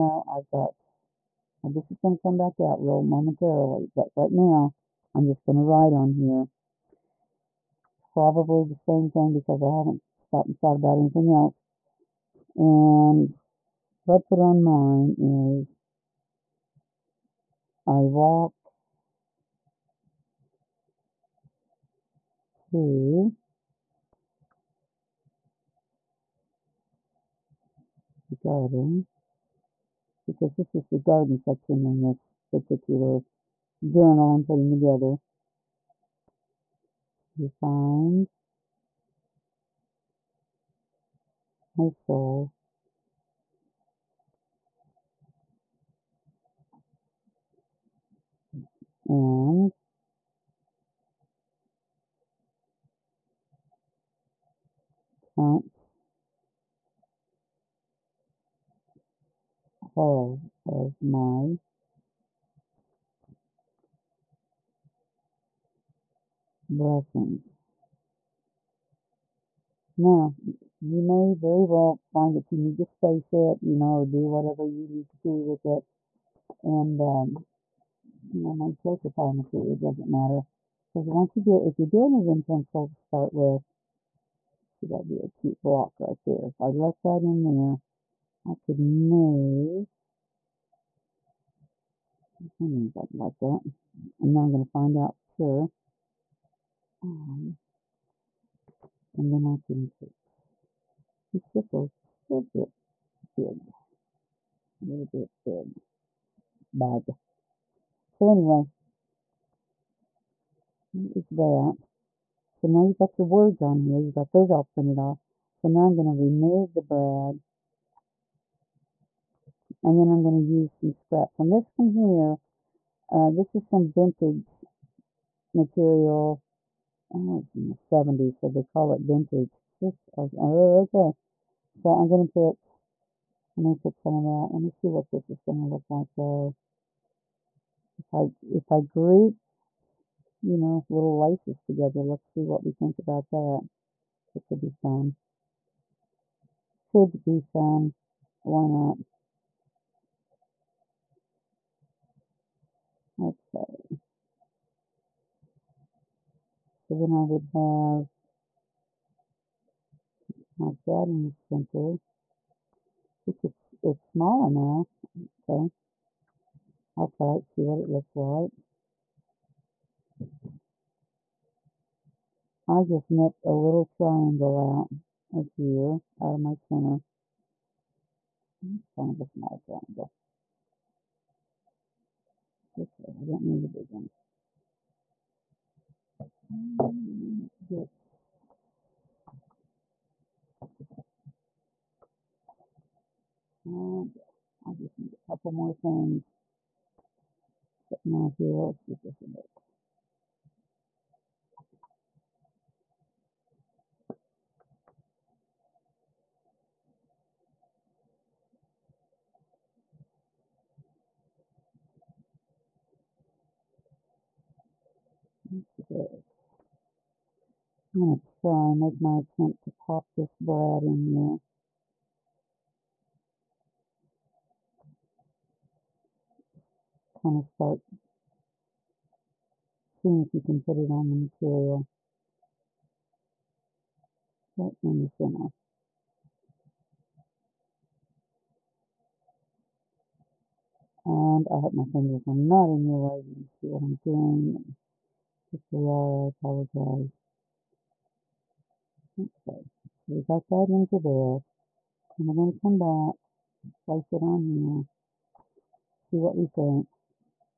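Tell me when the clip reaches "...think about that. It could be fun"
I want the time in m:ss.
2:22.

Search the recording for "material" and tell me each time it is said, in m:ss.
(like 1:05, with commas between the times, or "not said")
2:05, 3:51.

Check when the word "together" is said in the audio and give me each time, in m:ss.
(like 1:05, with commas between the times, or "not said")
0:34, 2:21.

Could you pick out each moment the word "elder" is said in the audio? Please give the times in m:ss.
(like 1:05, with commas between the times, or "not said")
not said.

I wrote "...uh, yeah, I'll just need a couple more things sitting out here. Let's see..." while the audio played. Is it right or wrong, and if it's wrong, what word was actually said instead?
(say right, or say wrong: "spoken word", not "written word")
right.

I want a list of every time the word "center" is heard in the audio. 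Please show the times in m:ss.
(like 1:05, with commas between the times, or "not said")
2:41, 2:56, 3:55.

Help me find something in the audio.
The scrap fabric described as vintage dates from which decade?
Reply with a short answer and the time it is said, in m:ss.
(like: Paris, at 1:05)
the 70s, at 2:07.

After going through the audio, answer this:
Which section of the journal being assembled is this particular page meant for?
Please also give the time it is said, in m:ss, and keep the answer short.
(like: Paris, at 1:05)
garden section, at 0:30.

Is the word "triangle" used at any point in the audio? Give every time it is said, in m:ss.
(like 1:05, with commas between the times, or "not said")
2:53, 2:59.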